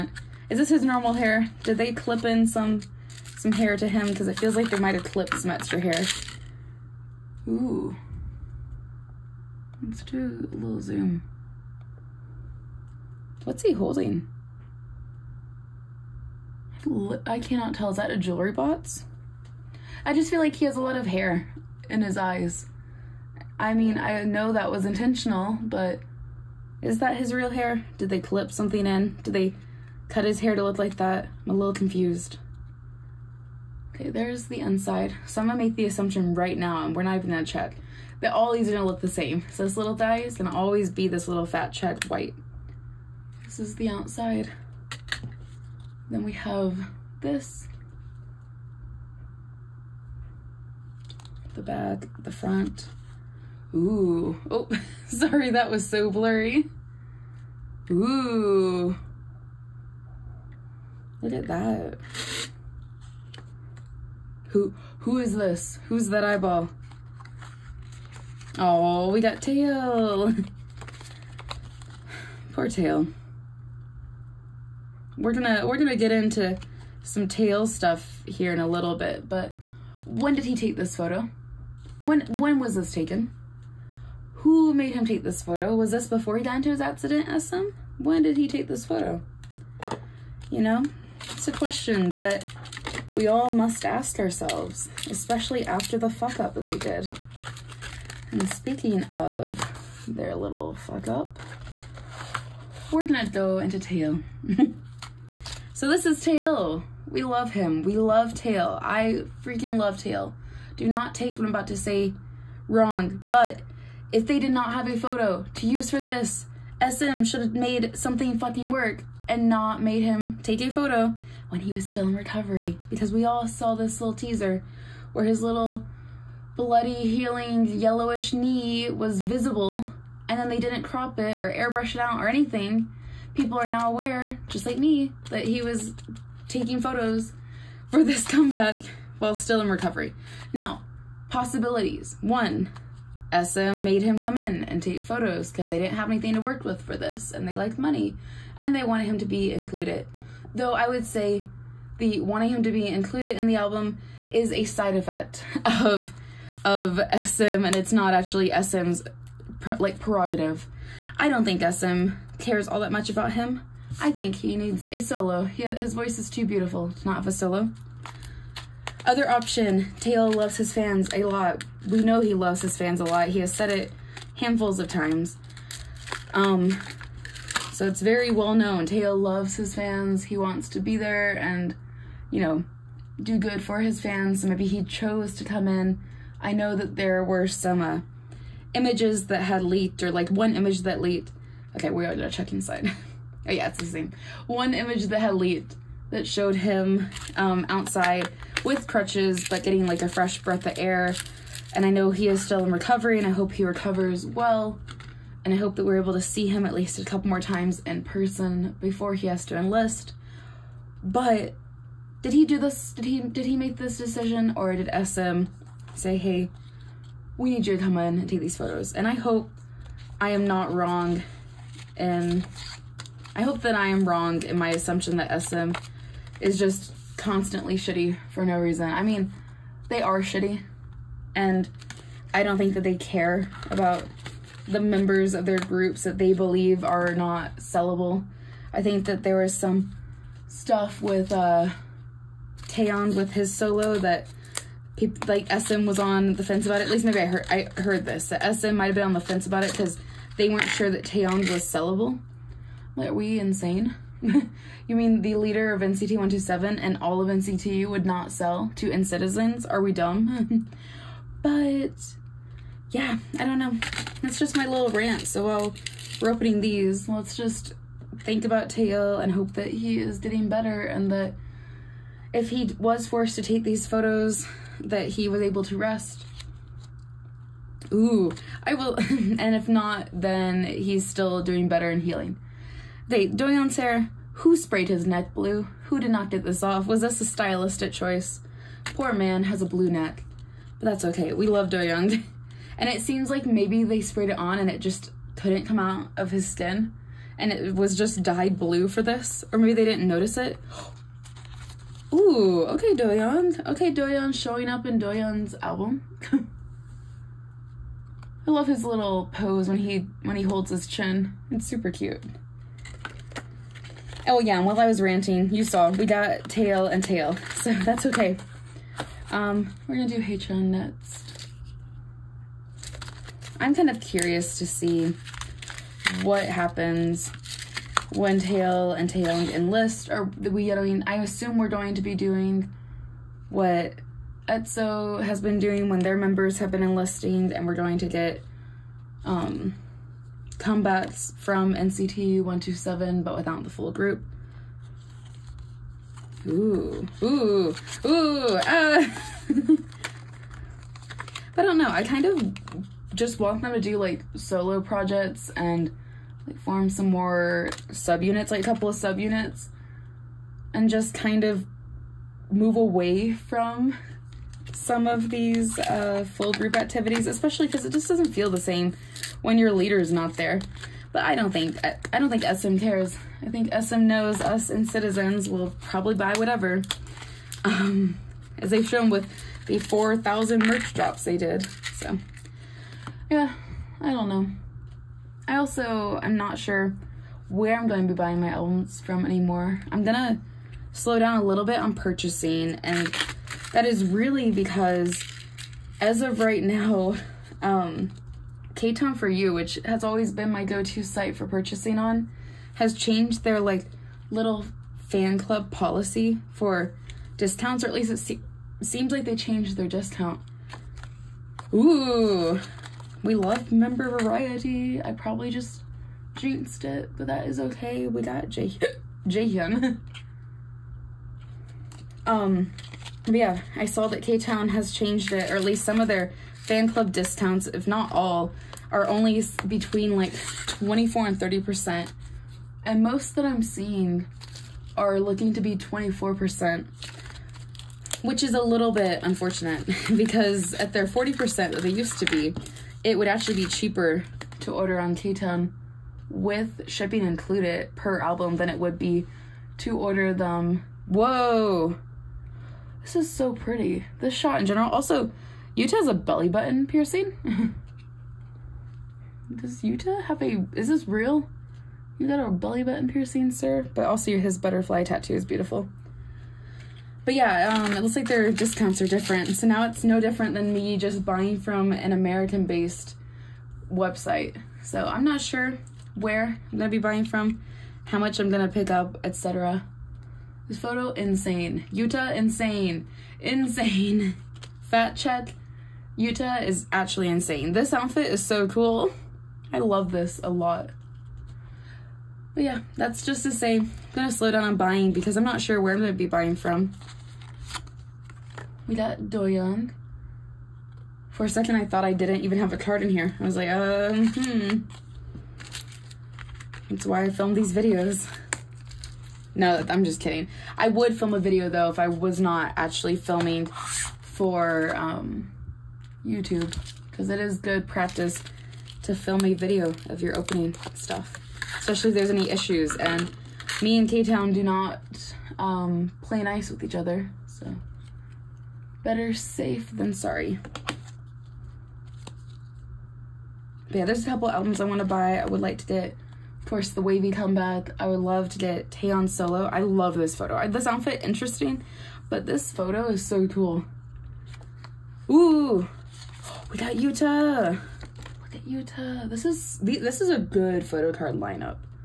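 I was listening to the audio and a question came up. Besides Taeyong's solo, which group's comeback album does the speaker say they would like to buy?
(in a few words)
WayV.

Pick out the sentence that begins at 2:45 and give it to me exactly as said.
He, his voice is too beautiful to not have a solo.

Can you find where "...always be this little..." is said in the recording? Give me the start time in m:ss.
0:40.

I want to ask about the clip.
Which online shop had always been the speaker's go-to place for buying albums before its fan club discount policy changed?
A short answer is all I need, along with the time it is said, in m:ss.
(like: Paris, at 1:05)
K-Town For You, at 6:38.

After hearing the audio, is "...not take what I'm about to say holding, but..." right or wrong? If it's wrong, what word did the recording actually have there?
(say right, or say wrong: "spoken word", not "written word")
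wrong: "wrong", not "holding".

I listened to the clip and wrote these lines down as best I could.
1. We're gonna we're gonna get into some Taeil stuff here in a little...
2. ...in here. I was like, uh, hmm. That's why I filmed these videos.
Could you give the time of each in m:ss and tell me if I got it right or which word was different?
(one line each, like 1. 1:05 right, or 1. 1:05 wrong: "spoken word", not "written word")
1. 1:15 right
2. 8:23 right.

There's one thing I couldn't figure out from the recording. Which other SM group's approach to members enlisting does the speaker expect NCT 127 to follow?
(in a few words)
EXO.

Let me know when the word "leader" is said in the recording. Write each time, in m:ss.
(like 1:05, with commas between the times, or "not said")
4:15, 6:09.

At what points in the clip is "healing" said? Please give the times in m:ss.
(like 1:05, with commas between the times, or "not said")
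2:06, 4:42.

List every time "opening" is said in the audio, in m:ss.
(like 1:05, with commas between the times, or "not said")
4:26, 8:40.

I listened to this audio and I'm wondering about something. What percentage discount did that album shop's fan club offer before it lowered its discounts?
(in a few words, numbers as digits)
40%.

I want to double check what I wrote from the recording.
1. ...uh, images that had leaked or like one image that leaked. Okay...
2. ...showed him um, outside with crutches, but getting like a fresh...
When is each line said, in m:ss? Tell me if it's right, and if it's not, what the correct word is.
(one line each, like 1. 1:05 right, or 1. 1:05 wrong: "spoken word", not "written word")
1. 3:07 right
2. 3:16 right.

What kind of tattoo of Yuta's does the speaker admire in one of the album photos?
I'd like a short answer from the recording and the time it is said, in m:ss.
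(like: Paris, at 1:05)
Butterfly, at 7:44.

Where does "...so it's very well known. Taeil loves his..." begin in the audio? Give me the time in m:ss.
2:57.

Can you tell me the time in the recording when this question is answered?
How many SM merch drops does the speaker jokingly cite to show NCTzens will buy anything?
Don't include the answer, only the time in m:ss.
6:19.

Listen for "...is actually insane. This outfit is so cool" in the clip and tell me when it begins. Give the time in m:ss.
8:06.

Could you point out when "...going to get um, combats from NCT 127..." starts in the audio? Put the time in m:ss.
5:37.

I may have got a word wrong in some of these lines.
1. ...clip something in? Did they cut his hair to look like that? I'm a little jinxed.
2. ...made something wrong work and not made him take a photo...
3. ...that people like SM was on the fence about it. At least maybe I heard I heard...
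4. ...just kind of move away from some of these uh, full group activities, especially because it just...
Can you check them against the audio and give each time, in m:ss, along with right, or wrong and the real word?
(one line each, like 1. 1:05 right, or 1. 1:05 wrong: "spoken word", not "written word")
1. 0:28 wrong: "confused", not "jinxed"
2. 1:57 wrong: "fucking", not "wrong"
3. 4:03 right
4. 6:00 right.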